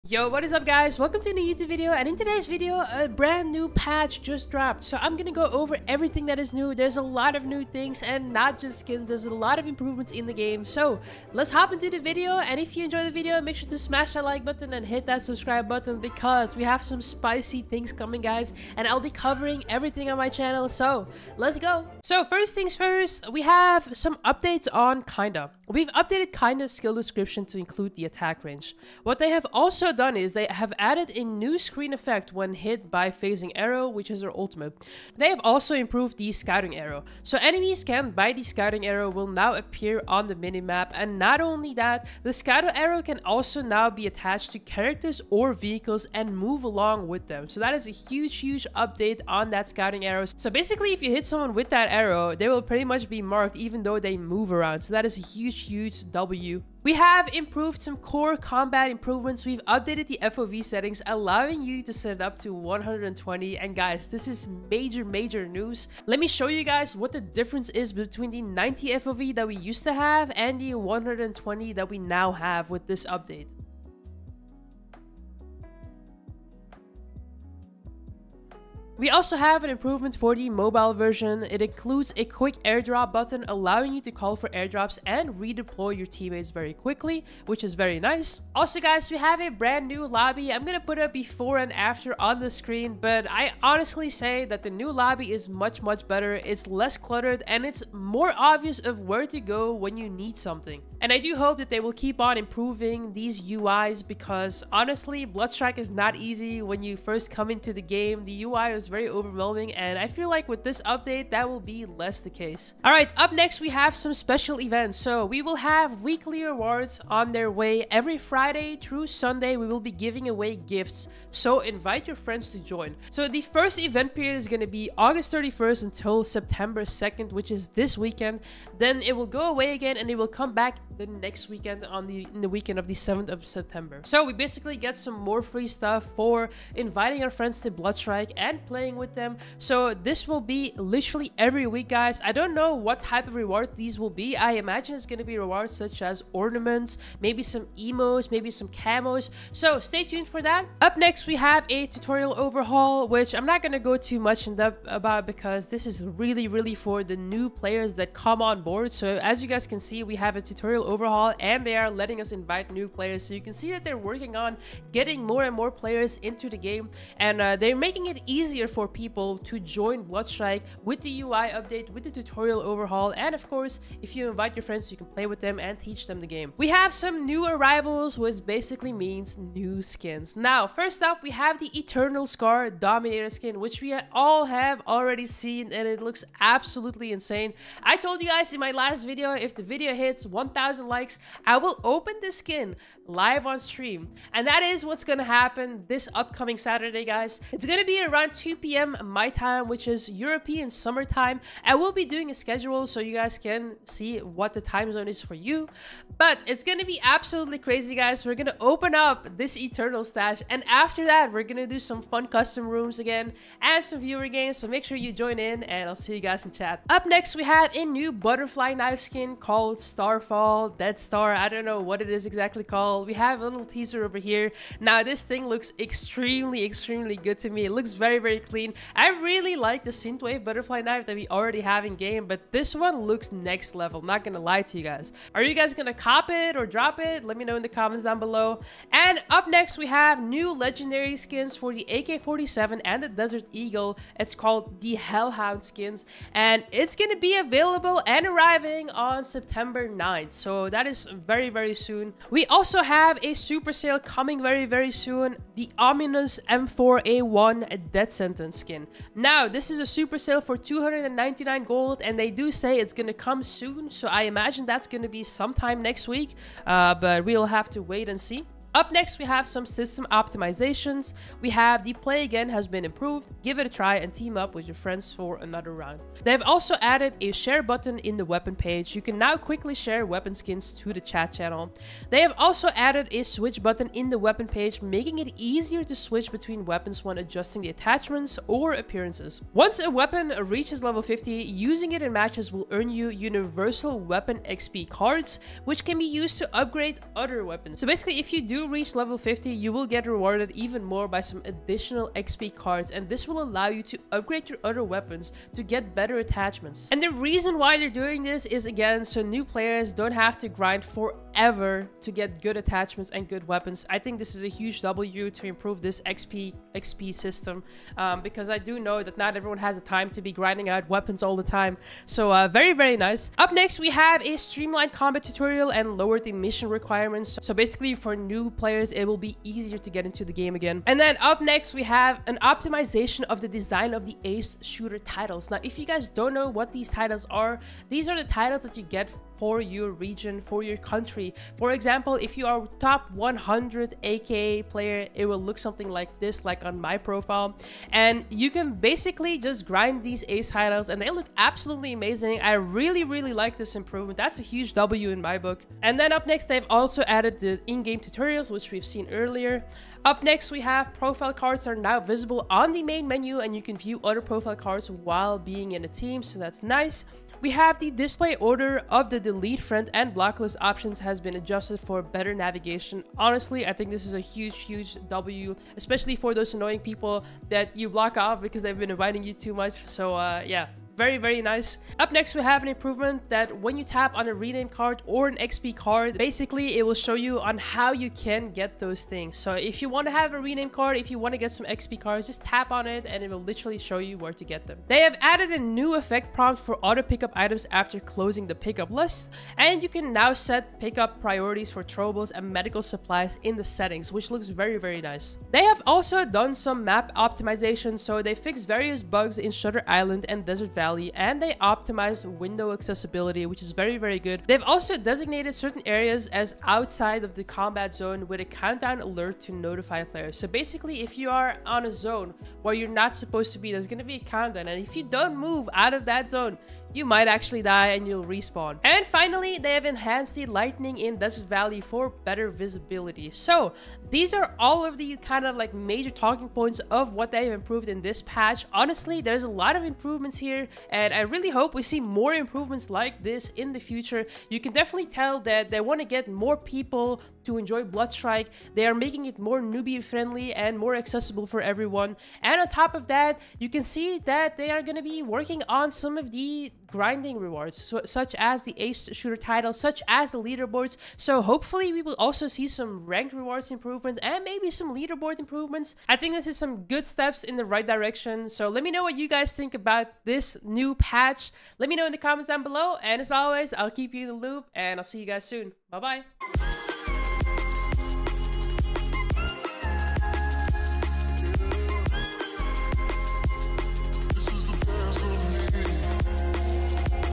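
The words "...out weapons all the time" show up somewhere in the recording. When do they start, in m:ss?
5:20.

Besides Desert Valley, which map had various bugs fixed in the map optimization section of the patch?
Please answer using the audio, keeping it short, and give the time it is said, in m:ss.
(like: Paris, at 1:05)
Shutter Island, at 6:49.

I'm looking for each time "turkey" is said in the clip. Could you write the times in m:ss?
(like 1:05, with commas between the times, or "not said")
not said.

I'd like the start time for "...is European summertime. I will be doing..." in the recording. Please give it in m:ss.
3:19.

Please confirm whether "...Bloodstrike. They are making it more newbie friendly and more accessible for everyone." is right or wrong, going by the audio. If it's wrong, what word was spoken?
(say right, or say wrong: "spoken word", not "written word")
right.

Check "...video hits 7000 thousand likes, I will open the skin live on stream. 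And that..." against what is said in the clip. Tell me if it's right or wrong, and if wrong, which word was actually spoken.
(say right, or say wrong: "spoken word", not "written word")
wrong: "1000", not "7000".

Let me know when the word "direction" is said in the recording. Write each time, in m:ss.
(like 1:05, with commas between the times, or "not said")
7:47.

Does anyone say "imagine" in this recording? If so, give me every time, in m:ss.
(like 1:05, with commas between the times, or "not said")
2:24, 4:24.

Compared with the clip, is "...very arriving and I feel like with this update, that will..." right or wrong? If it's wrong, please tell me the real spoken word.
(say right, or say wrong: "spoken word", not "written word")
wrong: "overwhelming", not "arriving".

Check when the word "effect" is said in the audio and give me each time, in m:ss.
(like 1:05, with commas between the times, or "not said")
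0:31, 6:35.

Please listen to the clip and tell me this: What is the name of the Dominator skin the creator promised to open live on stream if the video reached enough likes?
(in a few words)
Eternal Scar.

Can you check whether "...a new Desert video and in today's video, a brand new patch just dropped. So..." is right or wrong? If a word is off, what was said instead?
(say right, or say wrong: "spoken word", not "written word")
wrong: "YouTube", not "Desert".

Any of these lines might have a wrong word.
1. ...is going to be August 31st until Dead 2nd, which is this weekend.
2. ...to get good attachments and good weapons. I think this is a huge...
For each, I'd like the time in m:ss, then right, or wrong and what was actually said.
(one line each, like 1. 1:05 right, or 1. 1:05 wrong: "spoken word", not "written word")
1. 2:04 wrong: "September", not "Dead"
2. 5:12 right.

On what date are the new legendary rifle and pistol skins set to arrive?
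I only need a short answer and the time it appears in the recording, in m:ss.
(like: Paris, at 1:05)
September 9th, at 4:09.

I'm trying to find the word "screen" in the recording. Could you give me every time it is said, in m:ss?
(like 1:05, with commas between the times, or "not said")
0:31, 1:32.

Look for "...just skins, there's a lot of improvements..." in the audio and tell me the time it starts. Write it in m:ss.
0:08.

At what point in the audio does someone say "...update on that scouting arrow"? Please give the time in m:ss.
0:48.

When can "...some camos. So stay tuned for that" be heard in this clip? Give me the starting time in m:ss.
2:28.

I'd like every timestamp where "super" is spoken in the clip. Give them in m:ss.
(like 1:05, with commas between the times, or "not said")
4:13, 4:19.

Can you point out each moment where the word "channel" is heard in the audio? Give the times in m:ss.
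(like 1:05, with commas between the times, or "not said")
0:20, 4:41.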